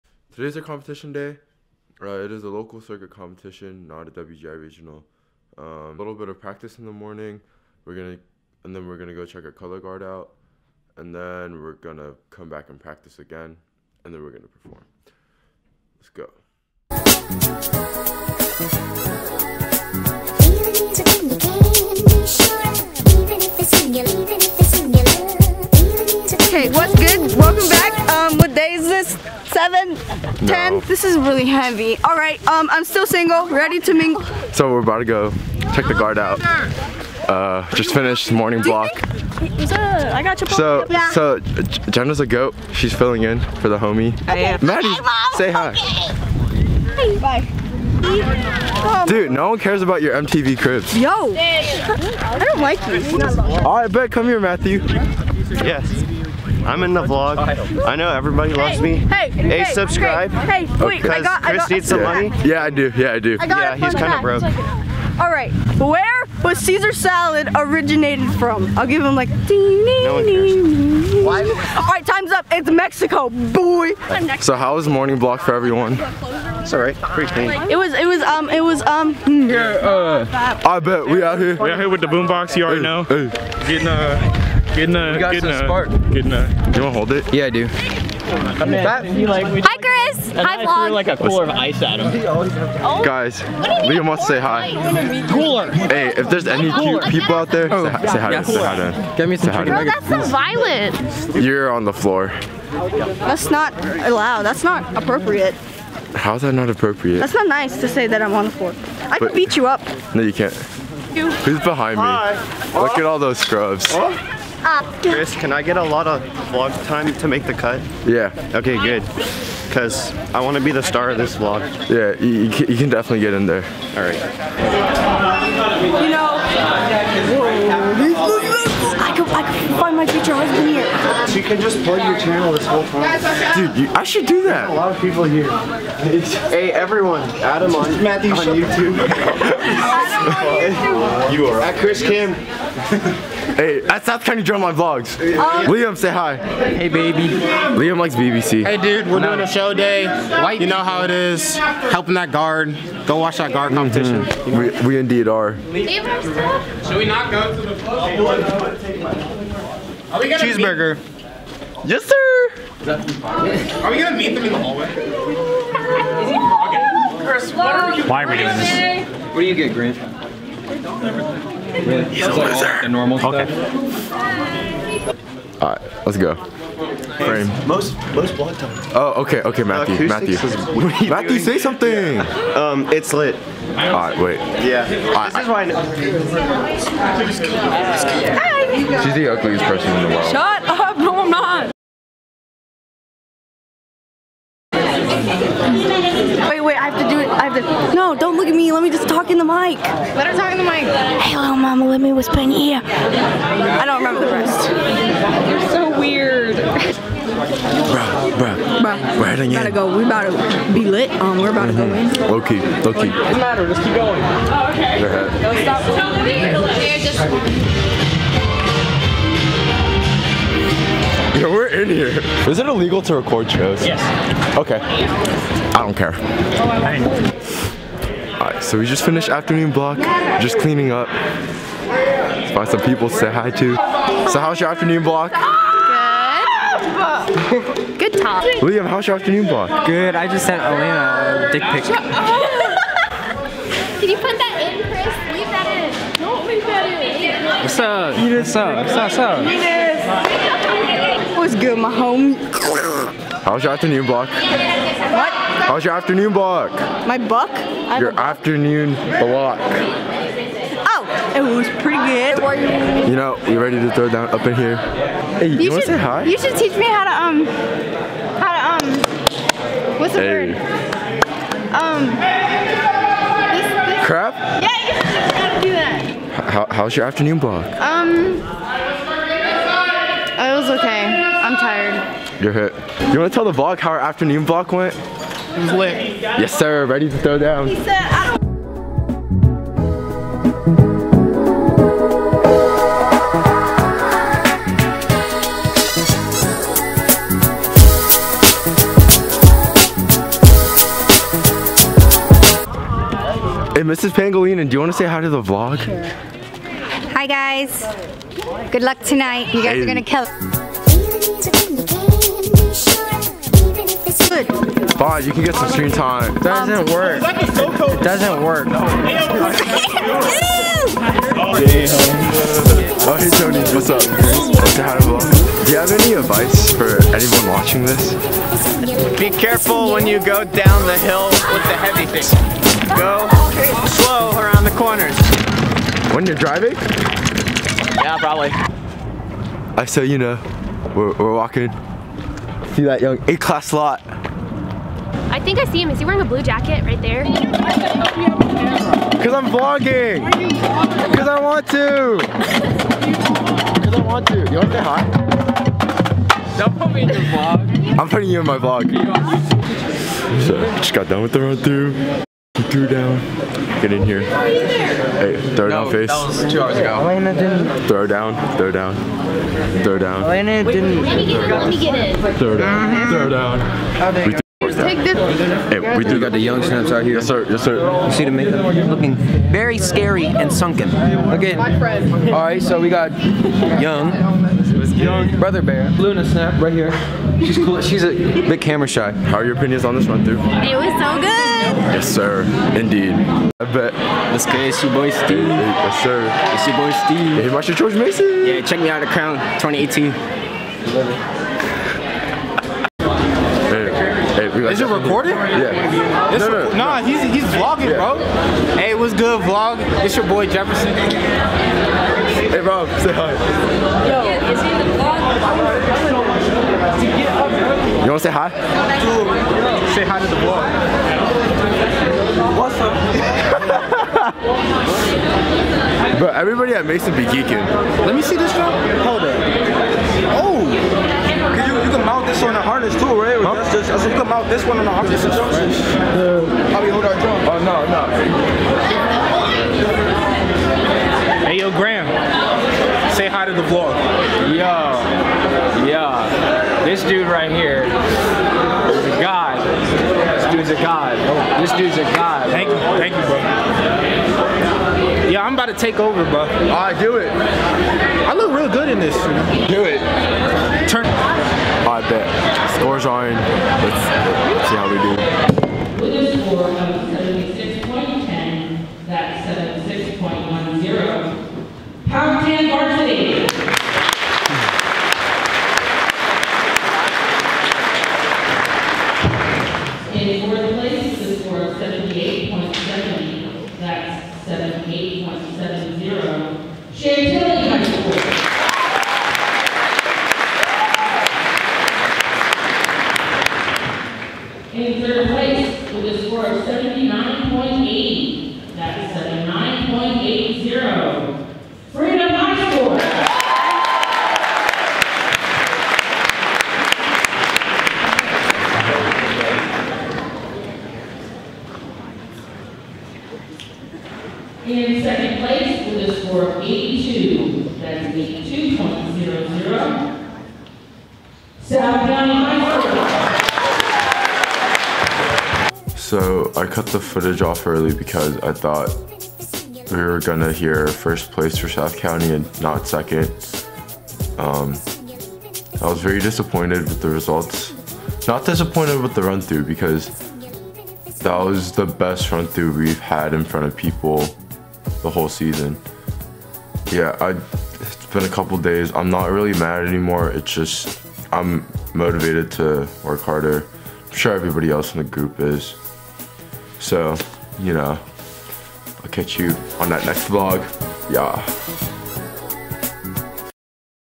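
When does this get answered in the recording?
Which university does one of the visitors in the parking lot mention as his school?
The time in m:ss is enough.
6:37.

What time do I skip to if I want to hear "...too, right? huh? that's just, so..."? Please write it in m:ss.
7:12.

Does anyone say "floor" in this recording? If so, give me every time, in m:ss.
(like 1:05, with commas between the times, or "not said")
1:41, 1:48.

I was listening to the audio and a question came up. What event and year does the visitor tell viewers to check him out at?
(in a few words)
Crown 2018.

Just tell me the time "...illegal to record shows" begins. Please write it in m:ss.
3:42.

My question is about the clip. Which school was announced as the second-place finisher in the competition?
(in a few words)
South County High School.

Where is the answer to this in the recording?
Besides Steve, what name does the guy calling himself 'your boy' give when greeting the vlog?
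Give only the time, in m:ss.
6:50.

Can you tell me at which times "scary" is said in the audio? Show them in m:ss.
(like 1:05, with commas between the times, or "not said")
6:19.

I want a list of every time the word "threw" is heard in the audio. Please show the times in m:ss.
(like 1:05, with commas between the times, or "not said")
1:30, 6:02.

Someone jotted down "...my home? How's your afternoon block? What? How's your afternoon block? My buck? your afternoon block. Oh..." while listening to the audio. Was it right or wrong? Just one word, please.
right.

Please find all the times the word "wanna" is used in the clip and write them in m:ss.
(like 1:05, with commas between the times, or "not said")
1:26, 4:25.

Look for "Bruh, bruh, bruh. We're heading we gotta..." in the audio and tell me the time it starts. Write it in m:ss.
3:26.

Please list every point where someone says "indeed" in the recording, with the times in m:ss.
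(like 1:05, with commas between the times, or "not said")
2:34, 6:32.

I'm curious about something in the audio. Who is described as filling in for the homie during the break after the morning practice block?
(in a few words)
Jenna.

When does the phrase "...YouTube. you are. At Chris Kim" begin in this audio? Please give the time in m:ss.
2:17.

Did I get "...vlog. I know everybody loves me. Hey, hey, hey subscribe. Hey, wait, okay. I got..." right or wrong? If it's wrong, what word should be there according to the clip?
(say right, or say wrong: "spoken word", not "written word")
right.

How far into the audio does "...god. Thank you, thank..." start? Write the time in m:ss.
7:32.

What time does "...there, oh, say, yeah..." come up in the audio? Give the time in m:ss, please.
1:37.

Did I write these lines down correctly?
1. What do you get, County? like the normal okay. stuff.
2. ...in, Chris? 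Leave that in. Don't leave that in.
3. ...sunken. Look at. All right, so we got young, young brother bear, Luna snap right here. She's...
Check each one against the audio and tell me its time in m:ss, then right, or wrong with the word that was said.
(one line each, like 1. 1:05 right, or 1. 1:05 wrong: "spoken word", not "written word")
1. 2:49 wrong: "Grant", not "County"
2. 4:04 right
3. 6:20 right.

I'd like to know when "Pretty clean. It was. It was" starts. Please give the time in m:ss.
1:16.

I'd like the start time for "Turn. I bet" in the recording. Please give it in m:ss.
7:40.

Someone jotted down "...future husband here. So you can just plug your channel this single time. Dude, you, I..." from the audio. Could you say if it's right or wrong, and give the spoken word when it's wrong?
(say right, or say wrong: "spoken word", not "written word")
wrong: "whole", not "single".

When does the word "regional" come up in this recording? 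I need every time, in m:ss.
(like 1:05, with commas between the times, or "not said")
0:04.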